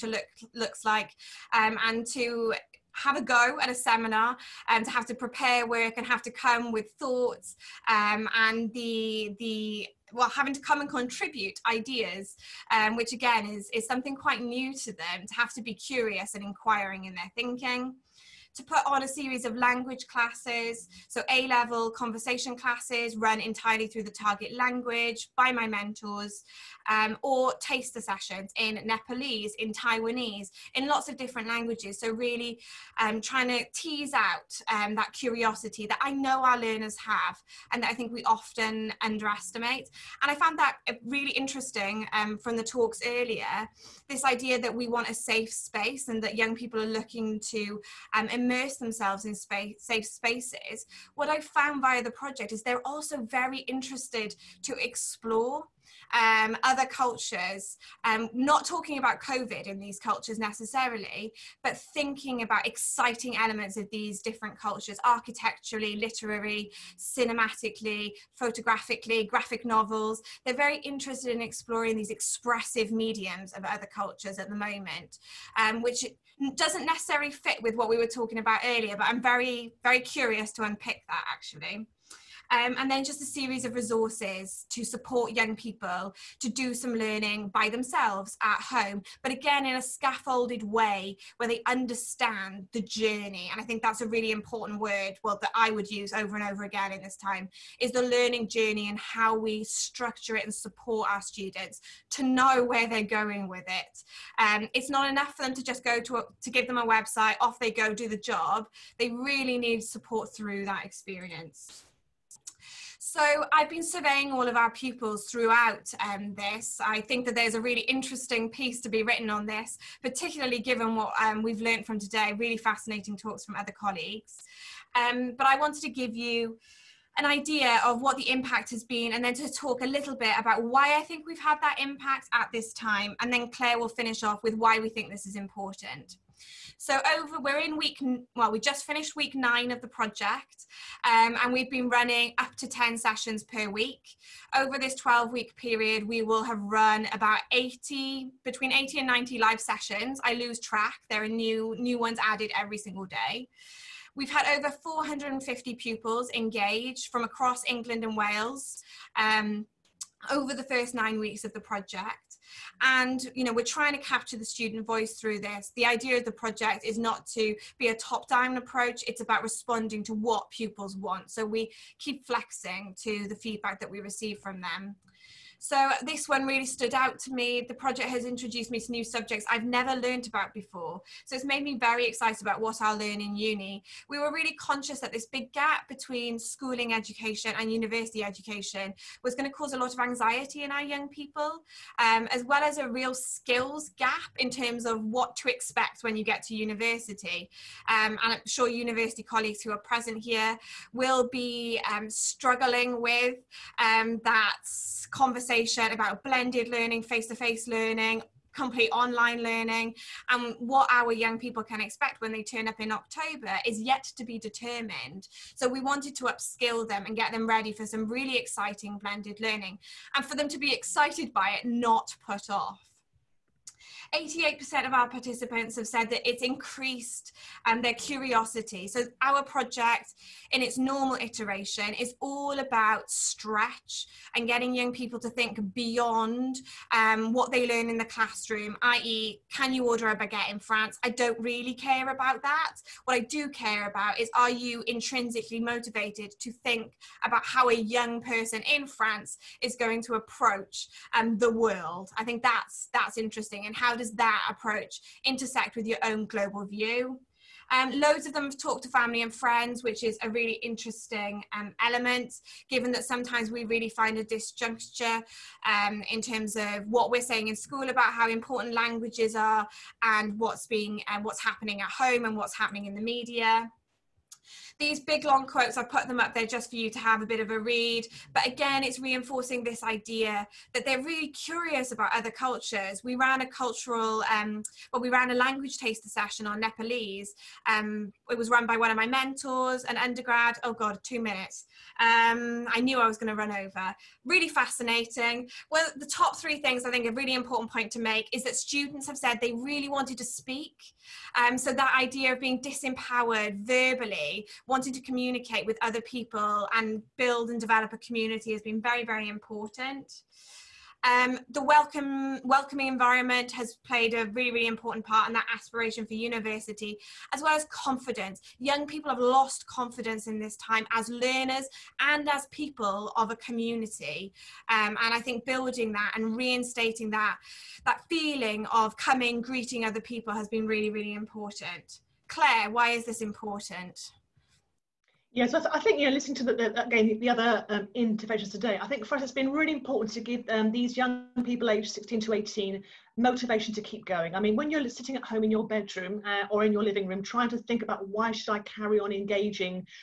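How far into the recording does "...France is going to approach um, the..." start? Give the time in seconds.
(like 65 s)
248 s.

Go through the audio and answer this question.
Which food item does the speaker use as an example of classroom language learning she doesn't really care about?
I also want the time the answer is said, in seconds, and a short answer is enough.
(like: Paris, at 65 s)
baguette, at 240 s.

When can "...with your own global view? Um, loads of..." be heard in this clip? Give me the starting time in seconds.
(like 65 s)
255 s.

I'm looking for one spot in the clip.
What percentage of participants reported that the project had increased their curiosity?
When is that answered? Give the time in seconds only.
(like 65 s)
224 s.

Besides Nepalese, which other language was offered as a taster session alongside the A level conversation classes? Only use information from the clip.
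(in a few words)
Taiwanese.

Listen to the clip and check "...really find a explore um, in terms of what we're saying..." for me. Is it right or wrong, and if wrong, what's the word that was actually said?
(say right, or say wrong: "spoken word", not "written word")
wrong: "disjuncture", not "explore".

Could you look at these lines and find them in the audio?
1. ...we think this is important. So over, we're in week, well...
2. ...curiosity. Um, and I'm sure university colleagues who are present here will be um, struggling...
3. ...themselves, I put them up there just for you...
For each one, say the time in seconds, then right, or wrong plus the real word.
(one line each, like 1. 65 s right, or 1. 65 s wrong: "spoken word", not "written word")
1. 134 s right
2. 196 s wrong: "university", not "curiosity"
3. 275 s wrong: "quotes", not "themselves".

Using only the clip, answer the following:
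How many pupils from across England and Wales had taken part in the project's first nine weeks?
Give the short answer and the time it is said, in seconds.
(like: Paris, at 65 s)
over 450, at 154 s.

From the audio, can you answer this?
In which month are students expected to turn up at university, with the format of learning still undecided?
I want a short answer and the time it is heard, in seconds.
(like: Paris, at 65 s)
October, at 212 s.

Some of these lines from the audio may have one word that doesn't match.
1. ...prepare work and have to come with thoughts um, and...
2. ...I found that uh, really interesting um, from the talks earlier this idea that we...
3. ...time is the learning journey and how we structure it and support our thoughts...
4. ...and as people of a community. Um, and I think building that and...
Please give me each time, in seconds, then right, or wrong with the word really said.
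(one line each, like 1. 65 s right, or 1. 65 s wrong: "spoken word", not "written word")
1. 5 s right
2. 40 s right
3. 97 s wrong: "students", not "thoughts"
4. 321 s right.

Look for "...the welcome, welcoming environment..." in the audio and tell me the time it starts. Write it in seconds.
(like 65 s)
311 s.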